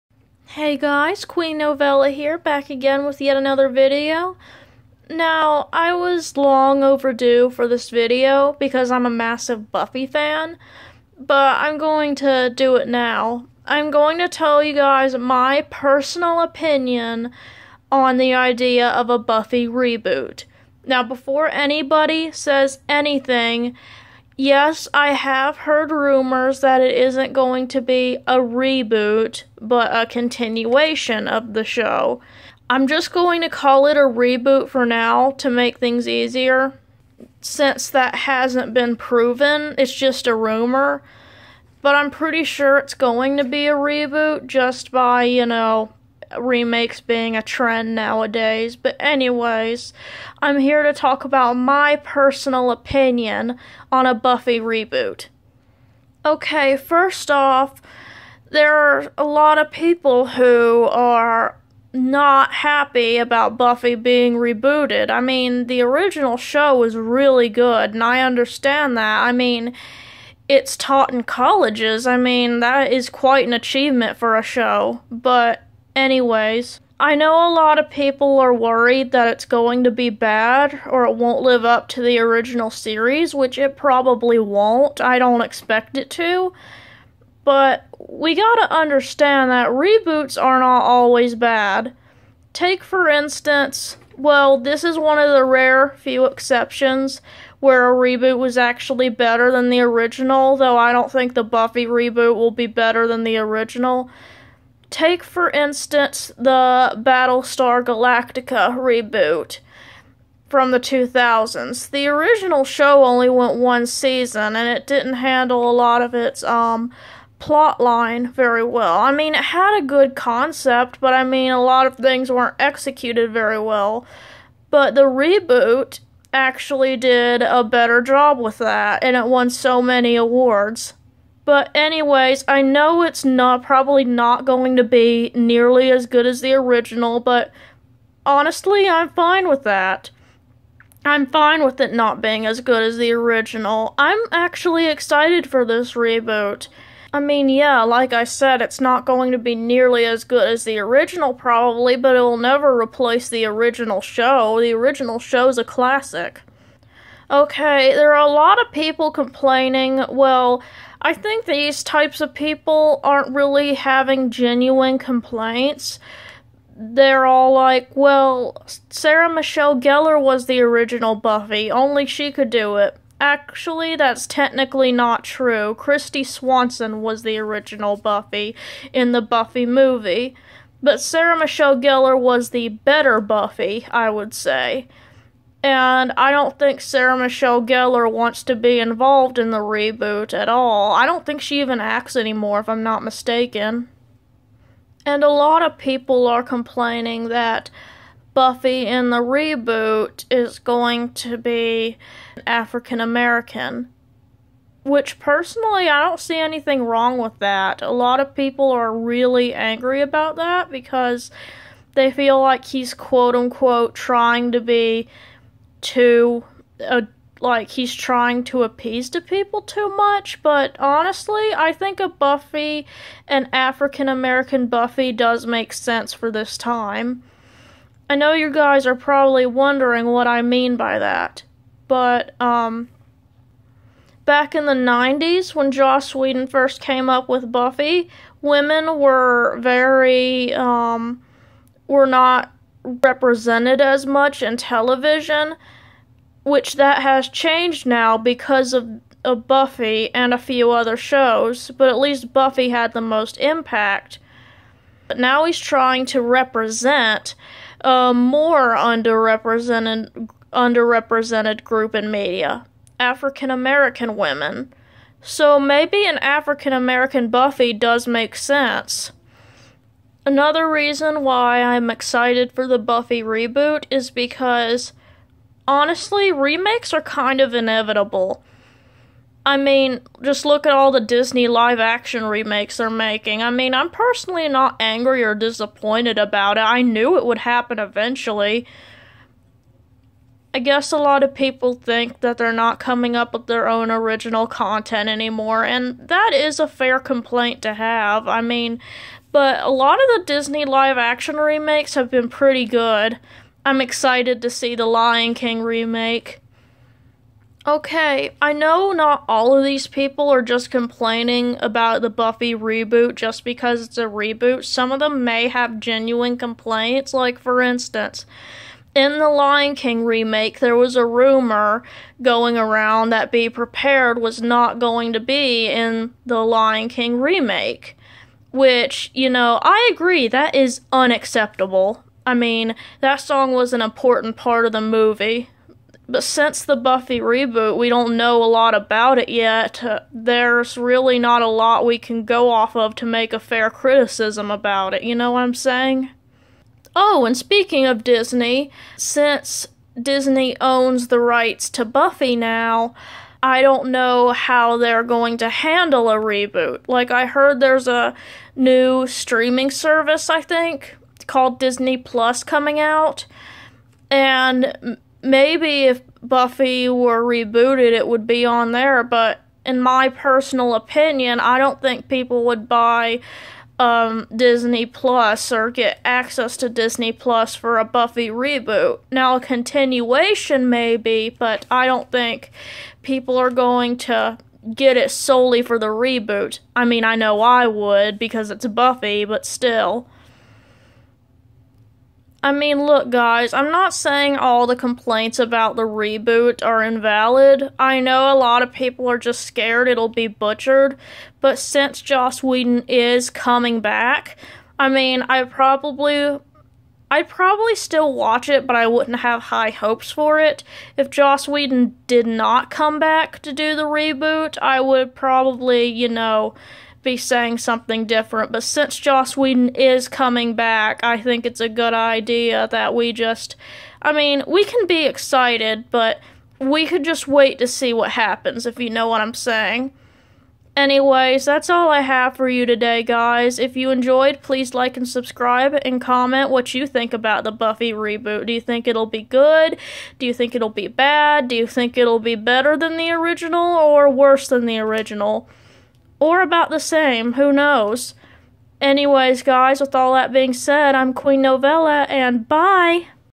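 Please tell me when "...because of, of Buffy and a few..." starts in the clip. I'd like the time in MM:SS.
04:08.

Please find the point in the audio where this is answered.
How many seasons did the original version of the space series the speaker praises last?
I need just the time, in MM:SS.
01:53.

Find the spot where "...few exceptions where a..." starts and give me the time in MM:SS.
01:35.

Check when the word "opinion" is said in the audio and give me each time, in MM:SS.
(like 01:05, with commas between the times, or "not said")
00:16, 00:52, 06:10.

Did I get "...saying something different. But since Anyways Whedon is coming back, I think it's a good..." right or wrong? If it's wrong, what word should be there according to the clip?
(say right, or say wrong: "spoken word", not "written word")
wrong: "Joss", not "Anyways".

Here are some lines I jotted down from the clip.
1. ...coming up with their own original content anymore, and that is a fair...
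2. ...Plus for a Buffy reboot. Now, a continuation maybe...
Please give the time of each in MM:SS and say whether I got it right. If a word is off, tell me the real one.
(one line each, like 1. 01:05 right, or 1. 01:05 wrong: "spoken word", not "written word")
1. 04:52 right
2. 06:17 right.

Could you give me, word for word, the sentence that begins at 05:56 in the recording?
Like, I heard there's a new streaming service, I think, called Disney Plus coming out.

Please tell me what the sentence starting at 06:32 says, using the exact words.
I mean, look, guys, I'm not saying all the complaints about the reboot are invalid.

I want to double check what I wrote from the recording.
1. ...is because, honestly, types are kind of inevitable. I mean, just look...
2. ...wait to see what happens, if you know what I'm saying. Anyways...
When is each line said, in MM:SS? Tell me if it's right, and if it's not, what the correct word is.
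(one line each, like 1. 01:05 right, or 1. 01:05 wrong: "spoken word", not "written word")
1. 04:33 wrong: "remakes", not "types"
2. 07:07 right.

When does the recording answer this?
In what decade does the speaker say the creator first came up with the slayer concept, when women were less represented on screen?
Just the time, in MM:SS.
03:54.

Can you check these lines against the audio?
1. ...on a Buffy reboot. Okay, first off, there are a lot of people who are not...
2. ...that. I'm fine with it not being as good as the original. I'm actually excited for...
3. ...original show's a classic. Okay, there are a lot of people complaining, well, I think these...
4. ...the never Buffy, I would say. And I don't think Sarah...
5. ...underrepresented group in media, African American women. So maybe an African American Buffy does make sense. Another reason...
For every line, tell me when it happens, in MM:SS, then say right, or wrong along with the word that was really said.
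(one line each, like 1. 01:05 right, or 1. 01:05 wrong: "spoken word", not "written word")
1. 00:53 right
2. 02:19 right
3. 02:34 right
4. 03:02 wrong: "better", not "never"
5. 04:20 right.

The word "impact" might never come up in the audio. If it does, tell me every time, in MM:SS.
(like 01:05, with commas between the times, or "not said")
04:13.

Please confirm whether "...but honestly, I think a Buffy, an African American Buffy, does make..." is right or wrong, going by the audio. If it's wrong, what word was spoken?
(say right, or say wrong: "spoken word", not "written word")
right.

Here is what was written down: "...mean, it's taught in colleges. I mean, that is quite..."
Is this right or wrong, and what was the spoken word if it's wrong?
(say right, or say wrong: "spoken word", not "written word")
right.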